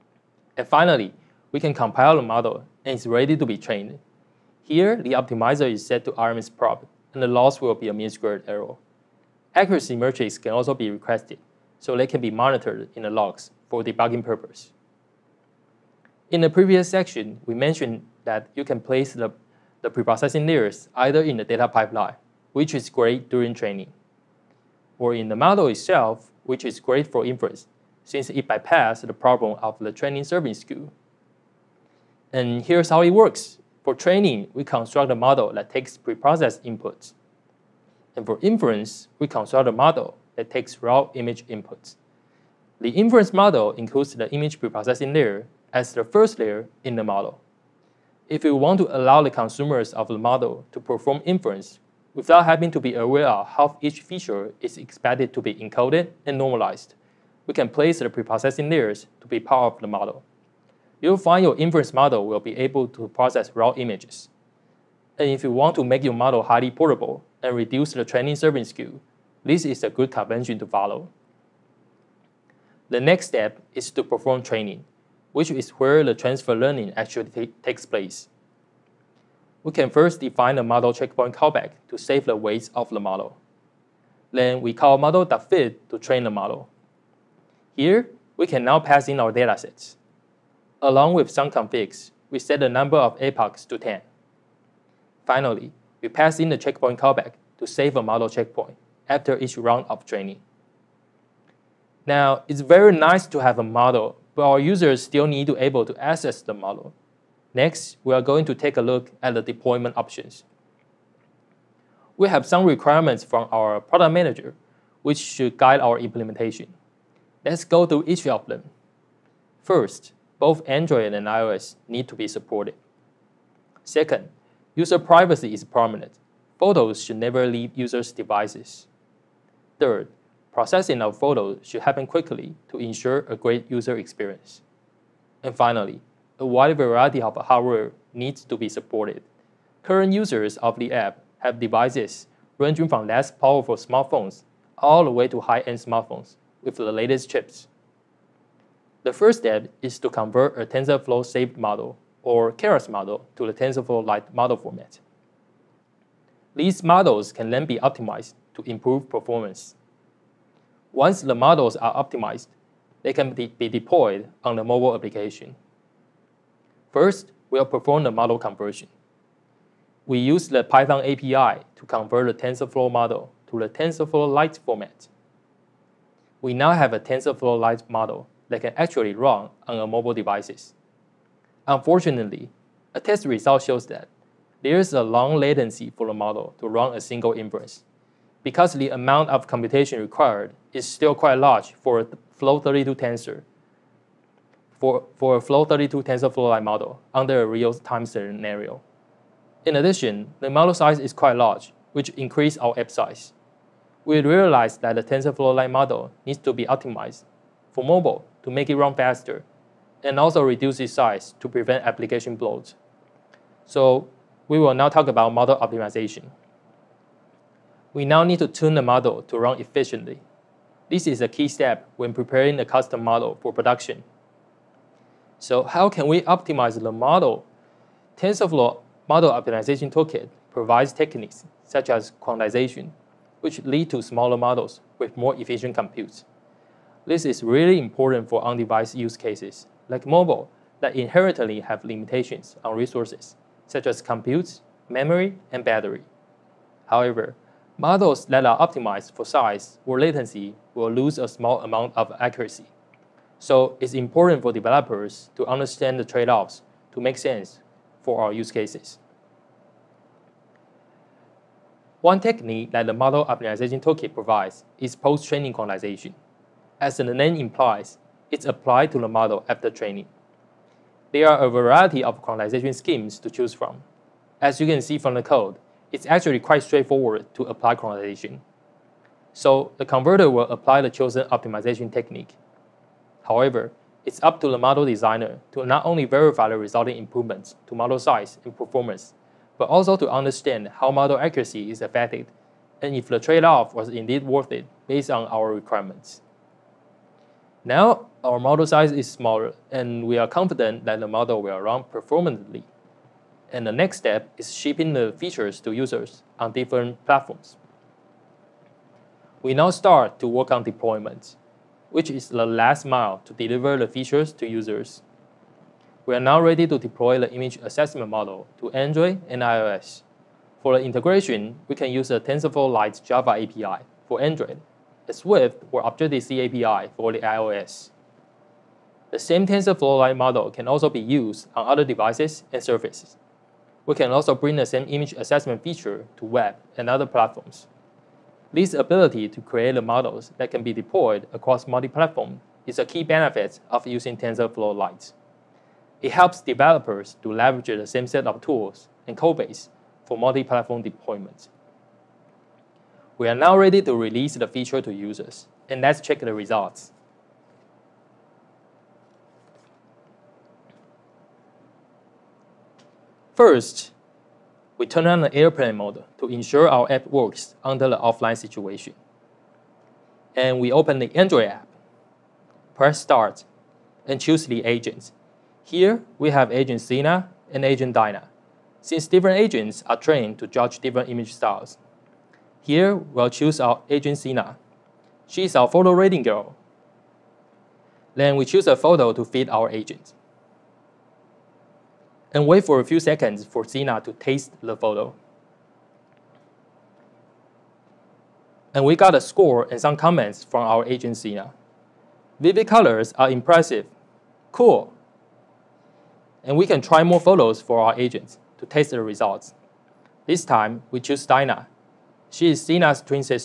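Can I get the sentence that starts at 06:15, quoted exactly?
Here, we have agent Sina and agent Dina.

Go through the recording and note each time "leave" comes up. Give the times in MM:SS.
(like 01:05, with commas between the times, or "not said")
02:07.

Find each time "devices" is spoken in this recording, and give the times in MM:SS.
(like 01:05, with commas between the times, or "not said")
02:08, 02:21, 03:00, 03:58, 05:31.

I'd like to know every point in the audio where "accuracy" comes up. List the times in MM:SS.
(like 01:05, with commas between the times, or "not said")
00:09, 04:12, 04:51.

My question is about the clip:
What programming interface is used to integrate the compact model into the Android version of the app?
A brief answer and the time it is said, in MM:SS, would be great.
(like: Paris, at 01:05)
TensorFlow Lite Java API, at 05:22.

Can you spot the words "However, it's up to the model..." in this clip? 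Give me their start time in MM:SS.
04:43.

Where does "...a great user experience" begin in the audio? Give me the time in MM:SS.
02:13.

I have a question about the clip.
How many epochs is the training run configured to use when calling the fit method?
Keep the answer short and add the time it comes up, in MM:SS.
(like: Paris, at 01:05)
10, at 01:33.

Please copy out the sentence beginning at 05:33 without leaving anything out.
We can also bring the same image assessment feature to web and other platforms.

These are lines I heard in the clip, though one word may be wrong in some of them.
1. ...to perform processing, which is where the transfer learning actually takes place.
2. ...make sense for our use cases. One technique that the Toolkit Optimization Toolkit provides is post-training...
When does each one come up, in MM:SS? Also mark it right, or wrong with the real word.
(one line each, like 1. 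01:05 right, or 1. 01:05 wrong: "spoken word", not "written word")
1. 01:13 wrong: "training", not "processing"
2. 04:16 wrong: "Model", not "Toolkit".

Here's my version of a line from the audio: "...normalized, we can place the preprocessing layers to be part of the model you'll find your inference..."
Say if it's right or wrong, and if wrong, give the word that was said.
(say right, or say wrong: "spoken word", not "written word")
right.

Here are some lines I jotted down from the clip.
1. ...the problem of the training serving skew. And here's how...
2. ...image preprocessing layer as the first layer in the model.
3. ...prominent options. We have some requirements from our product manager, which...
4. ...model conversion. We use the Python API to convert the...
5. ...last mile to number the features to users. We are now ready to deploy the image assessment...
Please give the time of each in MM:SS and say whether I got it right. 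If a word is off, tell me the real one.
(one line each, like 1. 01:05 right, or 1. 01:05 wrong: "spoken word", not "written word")
1. 00:29 right
2. 00:44 right
3. 01:49 wrong: "deployment", not "prominent"
4. 02:48 right
5. 05:12 wrong: "deliver", not "number".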